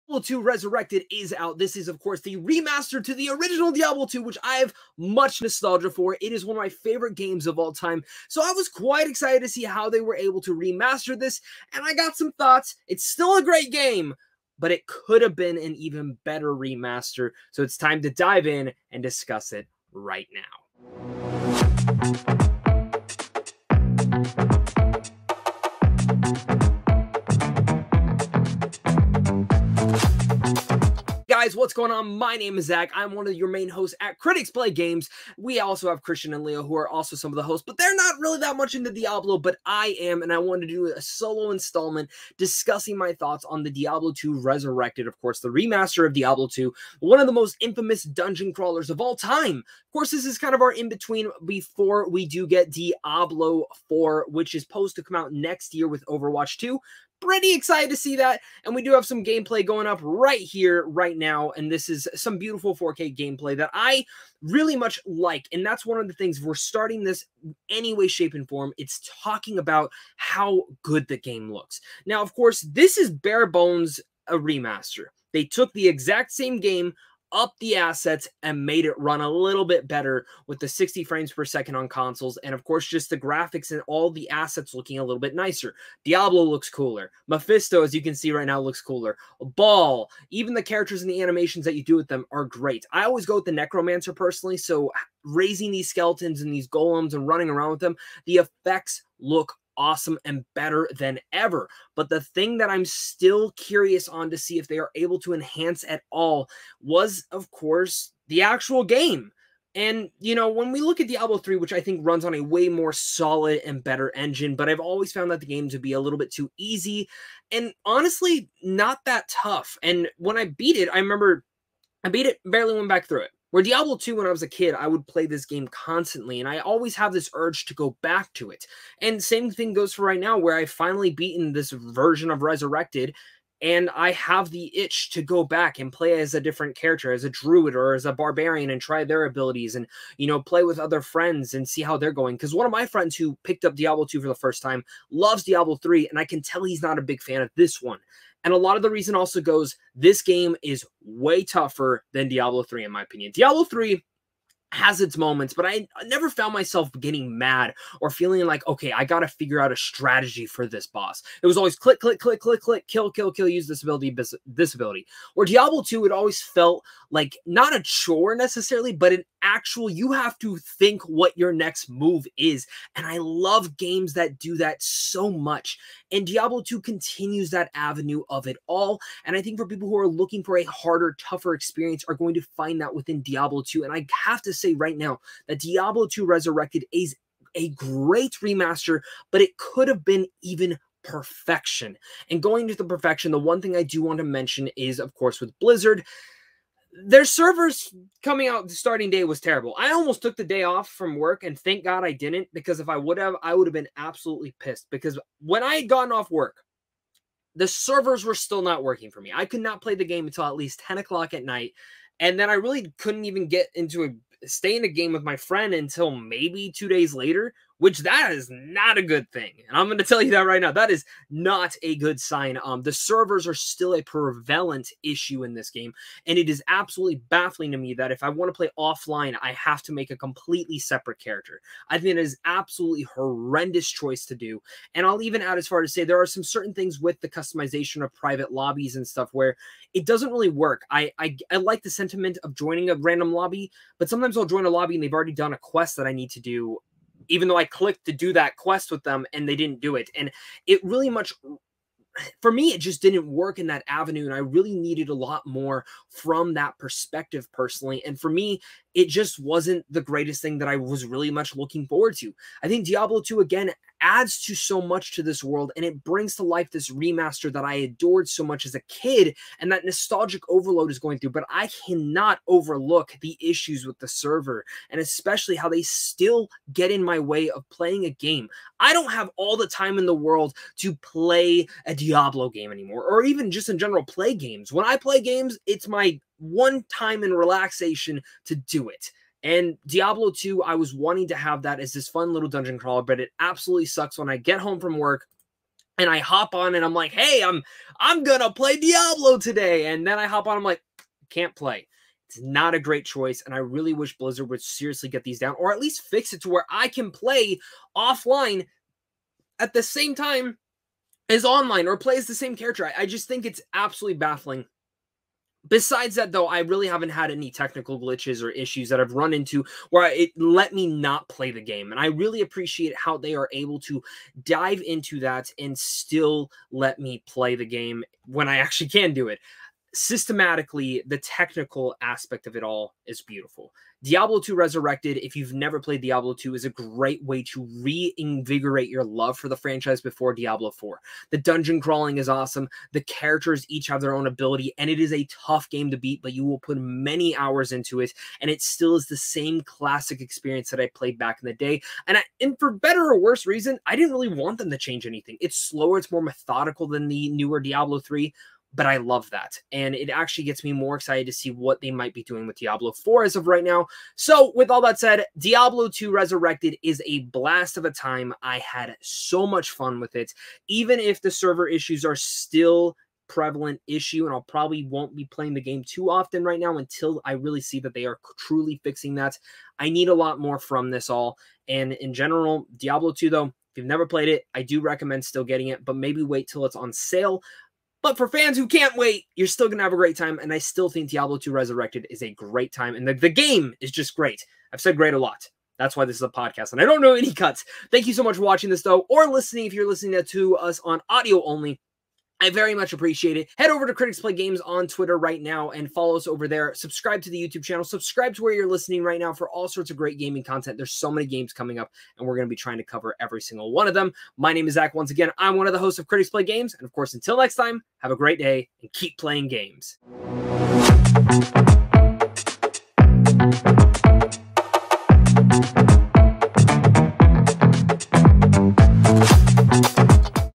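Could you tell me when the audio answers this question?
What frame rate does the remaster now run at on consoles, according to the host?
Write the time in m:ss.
1:20.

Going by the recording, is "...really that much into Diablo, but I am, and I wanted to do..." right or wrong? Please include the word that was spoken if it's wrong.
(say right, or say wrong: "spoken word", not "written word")
right.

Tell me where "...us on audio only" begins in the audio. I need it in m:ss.
6:40.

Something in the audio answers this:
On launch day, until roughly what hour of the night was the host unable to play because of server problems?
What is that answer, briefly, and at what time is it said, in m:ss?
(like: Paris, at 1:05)
10 o'clock, at 3:30.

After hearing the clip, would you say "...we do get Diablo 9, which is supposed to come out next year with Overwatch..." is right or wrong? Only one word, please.
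wrong.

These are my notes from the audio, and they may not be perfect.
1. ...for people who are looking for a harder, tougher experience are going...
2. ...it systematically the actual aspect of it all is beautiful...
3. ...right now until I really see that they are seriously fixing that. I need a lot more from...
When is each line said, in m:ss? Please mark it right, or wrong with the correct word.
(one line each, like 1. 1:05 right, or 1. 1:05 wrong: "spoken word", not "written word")
1. 2:59 right
2. 5:29 wrong: "technical", not "actual"
3. 6:16 wrong: "truly", not "seriously".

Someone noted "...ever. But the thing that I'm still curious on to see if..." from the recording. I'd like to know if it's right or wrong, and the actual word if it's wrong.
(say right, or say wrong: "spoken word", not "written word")
right.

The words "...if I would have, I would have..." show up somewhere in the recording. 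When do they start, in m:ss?
3:22.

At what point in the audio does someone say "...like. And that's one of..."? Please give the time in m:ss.
1:05.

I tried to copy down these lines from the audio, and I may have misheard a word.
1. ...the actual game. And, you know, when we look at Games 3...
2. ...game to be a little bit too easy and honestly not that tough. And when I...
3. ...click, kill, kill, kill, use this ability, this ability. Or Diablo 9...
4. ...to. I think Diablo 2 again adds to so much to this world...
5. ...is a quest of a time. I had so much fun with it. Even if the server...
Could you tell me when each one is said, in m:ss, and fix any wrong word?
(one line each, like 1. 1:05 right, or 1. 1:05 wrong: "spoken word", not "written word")
1. 1:48 wrong: "Diablo", not "Games"
2. 1:55 right
3. 2:42 wrong: "2", not "9"
4. 4:22 right
5. 6:06 wrong: "blast", not "quest".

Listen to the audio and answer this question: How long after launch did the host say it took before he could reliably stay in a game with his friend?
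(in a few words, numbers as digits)
two days.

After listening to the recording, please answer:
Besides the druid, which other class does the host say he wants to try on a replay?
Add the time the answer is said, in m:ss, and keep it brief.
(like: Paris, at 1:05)
barbarian, at 2:18.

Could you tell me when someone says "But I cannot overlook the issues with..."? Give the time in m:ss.
4:31.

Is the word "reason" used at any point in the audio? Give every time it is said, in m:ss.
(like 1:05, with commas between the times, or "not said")
2:28, 5:53.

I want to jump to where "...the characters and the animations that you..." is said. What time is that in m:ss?
1:30.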